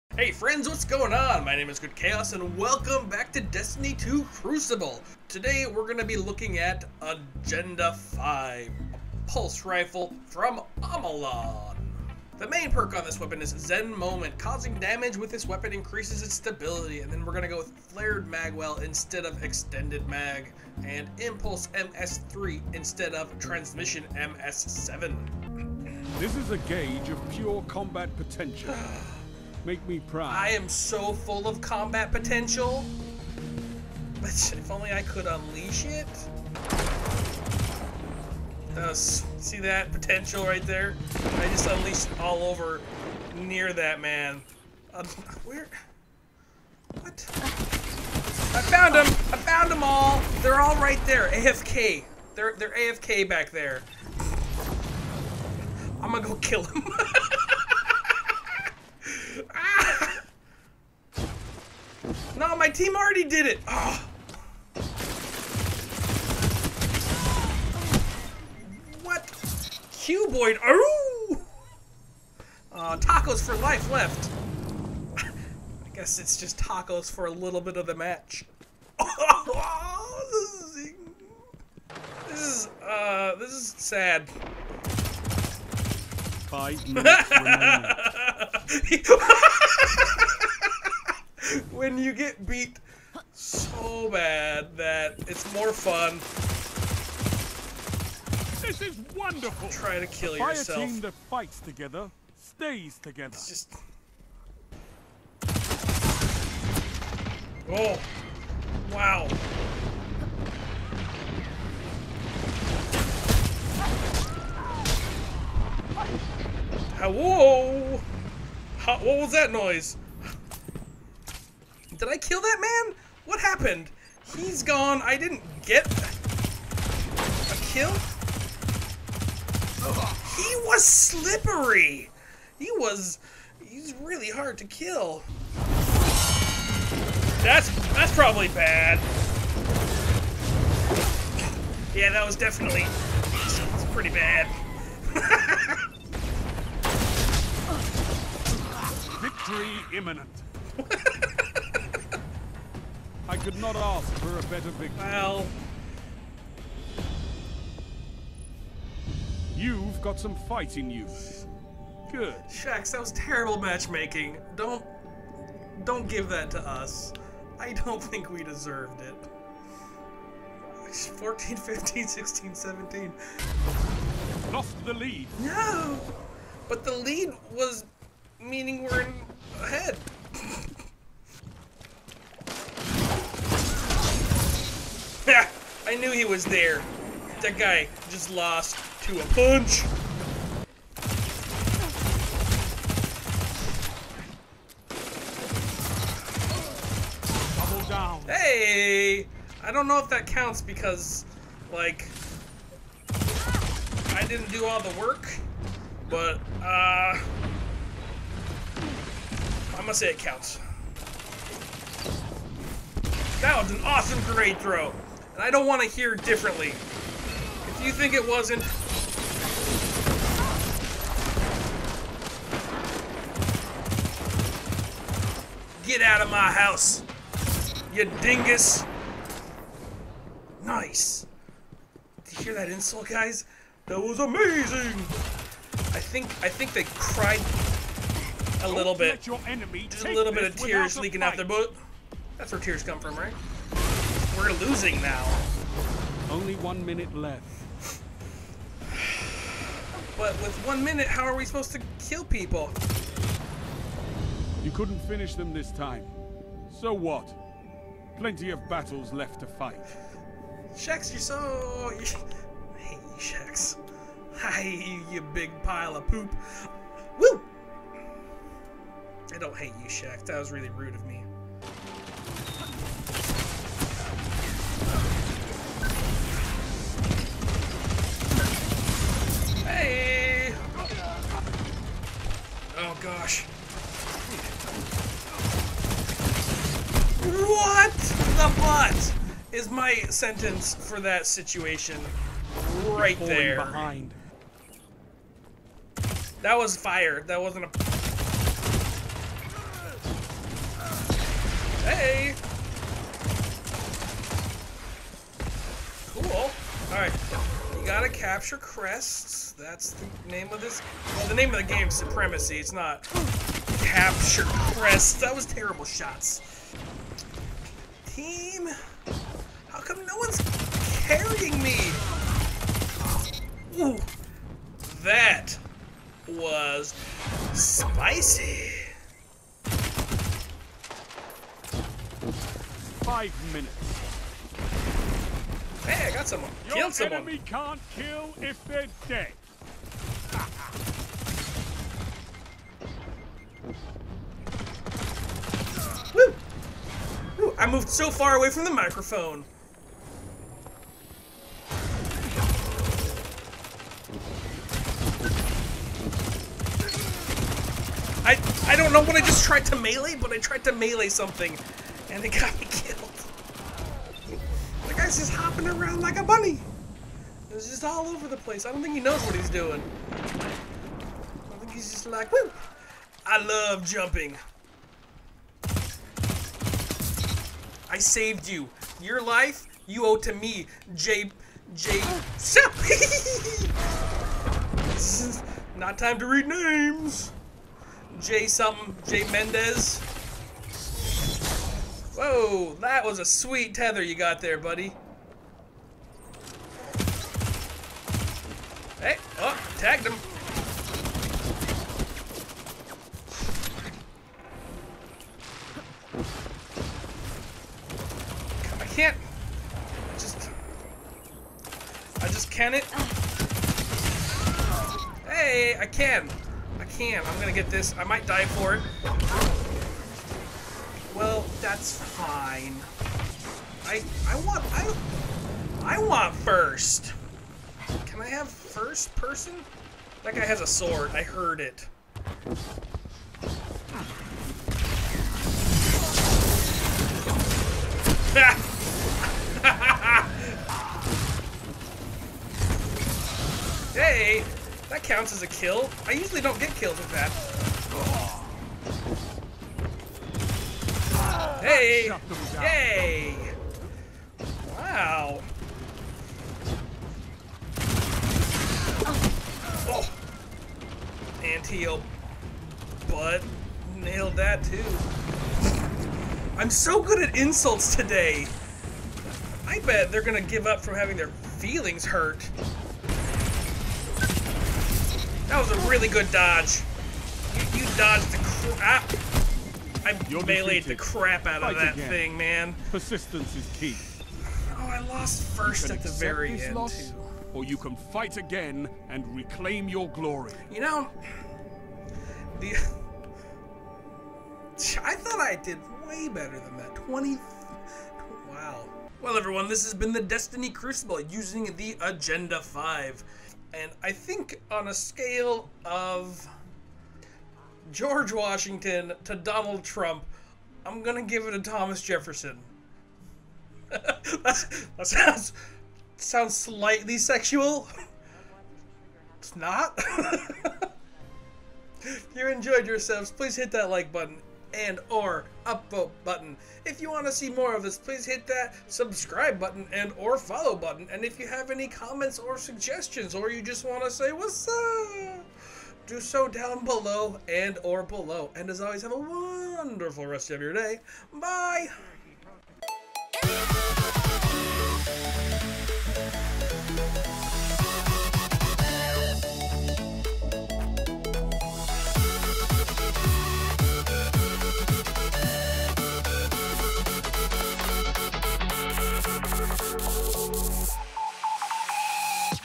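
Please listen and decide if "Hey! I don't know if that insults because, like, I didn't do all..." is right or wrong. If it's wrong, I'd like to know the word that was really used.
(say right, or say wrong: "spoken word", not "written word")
wrong: "counts", not "insults".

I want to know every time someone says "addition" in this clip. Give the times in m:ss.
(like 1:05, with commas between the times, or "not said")
not said.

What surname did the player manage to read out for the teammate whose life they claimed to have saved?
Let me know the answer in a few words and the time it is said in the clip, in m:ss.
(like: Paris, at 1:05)
Mendez, at 6:29.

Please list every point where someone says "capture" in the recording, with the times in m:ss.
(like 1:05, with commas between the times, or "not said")
5:08, 5:13.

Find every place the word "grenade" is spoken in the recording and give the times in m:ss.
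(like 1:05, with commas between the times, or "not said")
3:34.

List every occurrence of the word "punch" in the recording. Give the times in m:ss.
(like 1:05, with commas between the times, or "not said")
3:09.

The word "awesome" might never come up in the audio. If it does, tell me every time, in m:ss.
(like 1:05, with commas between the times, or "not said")
3:33.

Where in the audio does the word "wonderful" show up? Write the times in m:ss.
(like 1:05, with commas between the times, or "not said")
1:39, 8:59.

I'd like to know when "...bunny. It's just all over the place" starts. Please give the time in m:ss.
6:06.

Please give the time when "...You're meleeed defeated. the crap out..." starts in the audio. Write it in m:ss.
8:00.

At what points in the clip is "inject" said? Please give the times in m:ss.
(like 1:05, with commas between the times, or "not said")
not said.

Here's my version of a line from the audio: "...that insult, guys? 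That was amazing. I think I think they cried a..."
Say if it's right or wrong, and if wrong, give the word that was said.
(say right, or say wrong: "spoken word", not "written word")
right.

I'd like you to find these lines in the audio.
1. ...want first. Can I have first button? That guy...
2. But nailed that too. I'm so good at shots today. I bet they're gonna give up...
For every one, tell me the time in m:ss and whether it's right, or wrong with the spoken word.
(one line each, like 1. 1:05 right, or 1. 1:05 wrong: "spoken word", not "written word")
1. 7:05 wrong: "person", not "button"
2. 7:43 wrong: "insults", not "shots".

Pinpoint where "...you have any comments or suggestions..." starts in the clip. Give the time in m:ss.
8:51.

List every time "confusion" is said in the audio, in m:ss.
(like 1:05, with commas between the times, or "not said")
not said.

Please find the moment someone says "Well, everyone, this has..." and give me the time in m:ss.
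8:19.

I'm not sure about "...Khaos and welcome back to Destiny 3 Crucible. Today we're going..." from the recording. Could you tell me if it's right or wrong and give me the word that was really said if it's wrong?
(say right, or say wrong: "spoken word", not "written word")
wrong: "2", not "3".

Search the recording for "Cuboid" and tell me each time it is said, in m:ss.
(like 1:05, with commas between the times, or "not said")
1:09.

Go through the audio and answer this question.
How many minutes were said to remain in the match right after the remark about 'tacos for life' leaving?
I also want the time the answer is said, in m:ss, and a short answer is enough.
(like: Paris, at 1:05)
5, at 1:26.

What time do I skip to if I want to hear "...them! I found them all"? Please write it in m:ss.
0:48.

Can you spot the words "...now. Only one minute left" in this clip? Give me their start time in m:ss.
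4:05.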